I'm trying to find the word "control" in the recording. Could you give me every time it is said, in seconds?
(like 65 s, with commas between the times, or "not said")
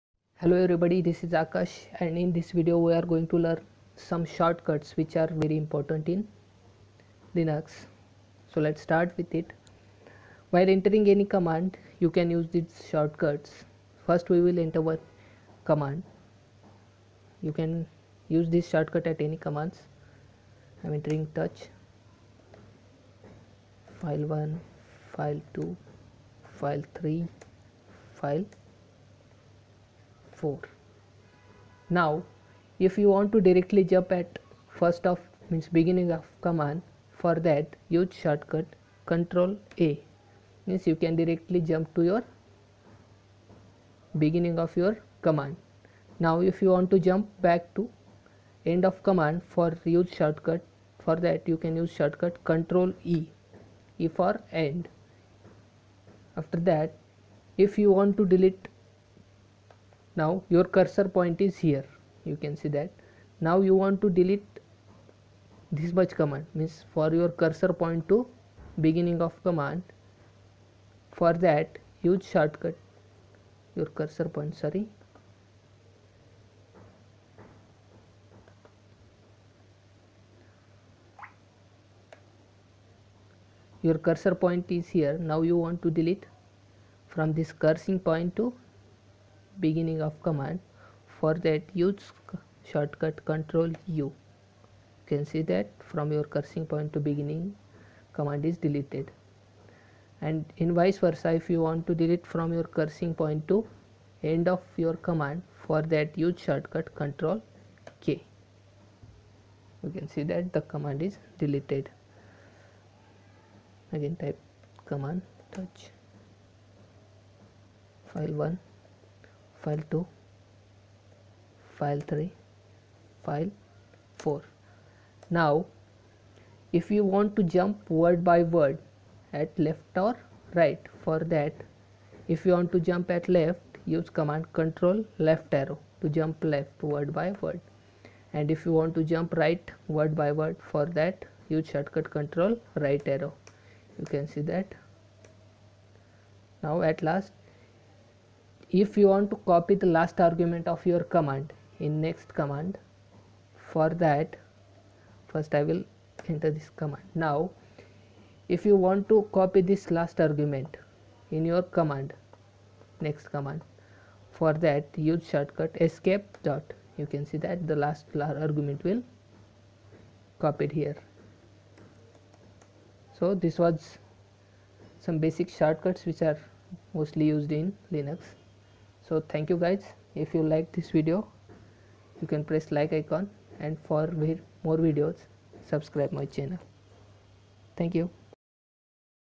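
39 s, 52 s, 93 s, 106 s, 134 s, 142 s.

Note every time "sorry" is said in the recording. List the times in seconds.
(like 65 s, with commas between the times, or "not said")
74 s.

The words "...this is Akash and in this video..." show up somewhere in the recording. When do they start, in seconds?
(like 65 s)
1 s.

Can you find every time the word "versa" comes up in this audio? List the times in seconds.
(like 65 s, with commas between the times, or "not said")
101 s.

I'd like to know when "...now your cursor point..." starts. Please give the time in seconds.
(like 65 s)
60 s.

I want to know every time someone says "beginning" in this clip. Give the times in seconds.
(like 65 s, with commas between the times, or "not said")
35 s, 44 s, 68 s, 89 s, 96 s.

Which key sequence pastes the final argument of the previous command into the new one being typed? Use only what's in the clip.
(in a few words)
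Escape dot.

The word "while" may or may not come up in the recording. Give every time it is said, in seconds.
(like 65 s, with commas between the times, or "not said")
10 s.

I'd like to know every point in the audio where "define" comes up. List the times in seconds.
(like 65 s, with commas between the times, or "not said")
not said.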